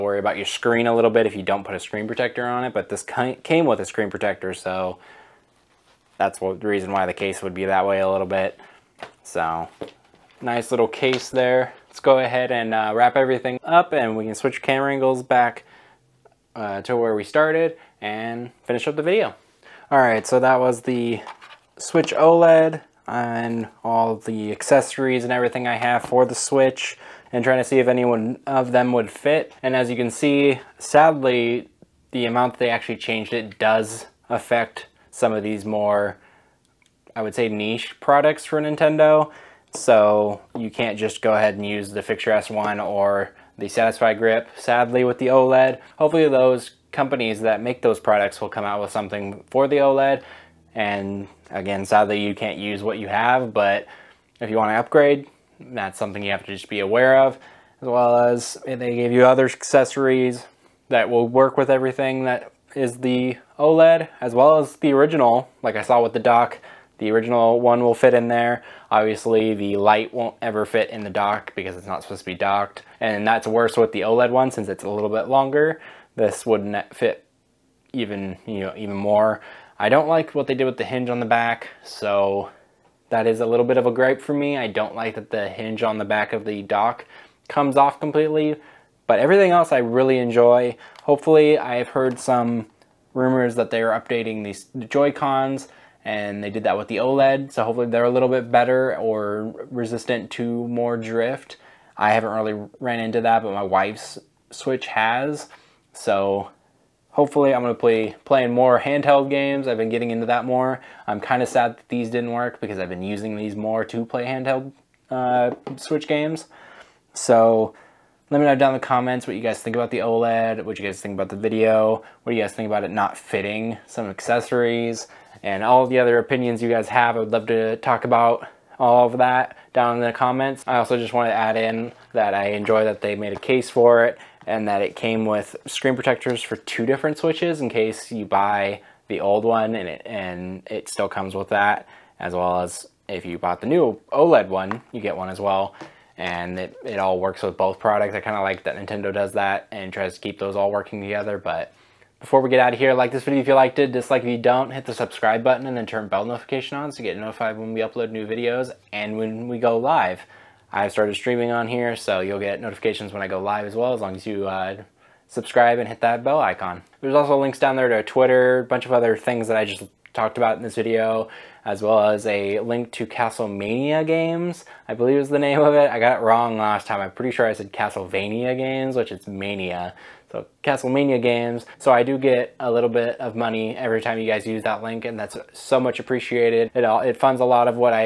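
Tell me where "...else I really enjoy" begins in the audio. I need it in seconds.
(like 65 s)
89 s.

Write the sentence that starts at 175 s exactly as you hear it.
I got it wrong last time.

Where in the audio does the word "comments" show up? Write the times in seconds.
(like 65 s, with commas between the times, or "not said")
118 s, 130 s.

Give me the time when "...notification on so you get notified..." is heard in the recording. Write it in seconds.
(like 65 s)
156 s.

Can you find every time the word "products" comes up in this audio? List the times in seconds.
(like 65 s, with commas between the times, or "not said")
38 s, 47 s, 147 s.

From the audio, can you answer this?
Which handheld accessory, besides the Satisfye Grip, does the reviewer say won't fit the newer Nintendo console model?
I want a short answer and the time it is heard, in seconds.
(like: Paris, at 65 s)
Fixture S1, at 42 s.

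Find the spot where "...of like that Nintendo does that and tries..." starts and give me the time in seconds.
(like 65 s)
148 s.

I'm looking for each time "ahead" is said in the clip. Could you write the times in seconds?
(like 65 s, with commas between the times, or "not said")
12 s, 41 s.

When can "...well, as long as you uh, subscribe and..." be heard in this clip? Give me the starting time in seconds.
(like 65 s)
163 s.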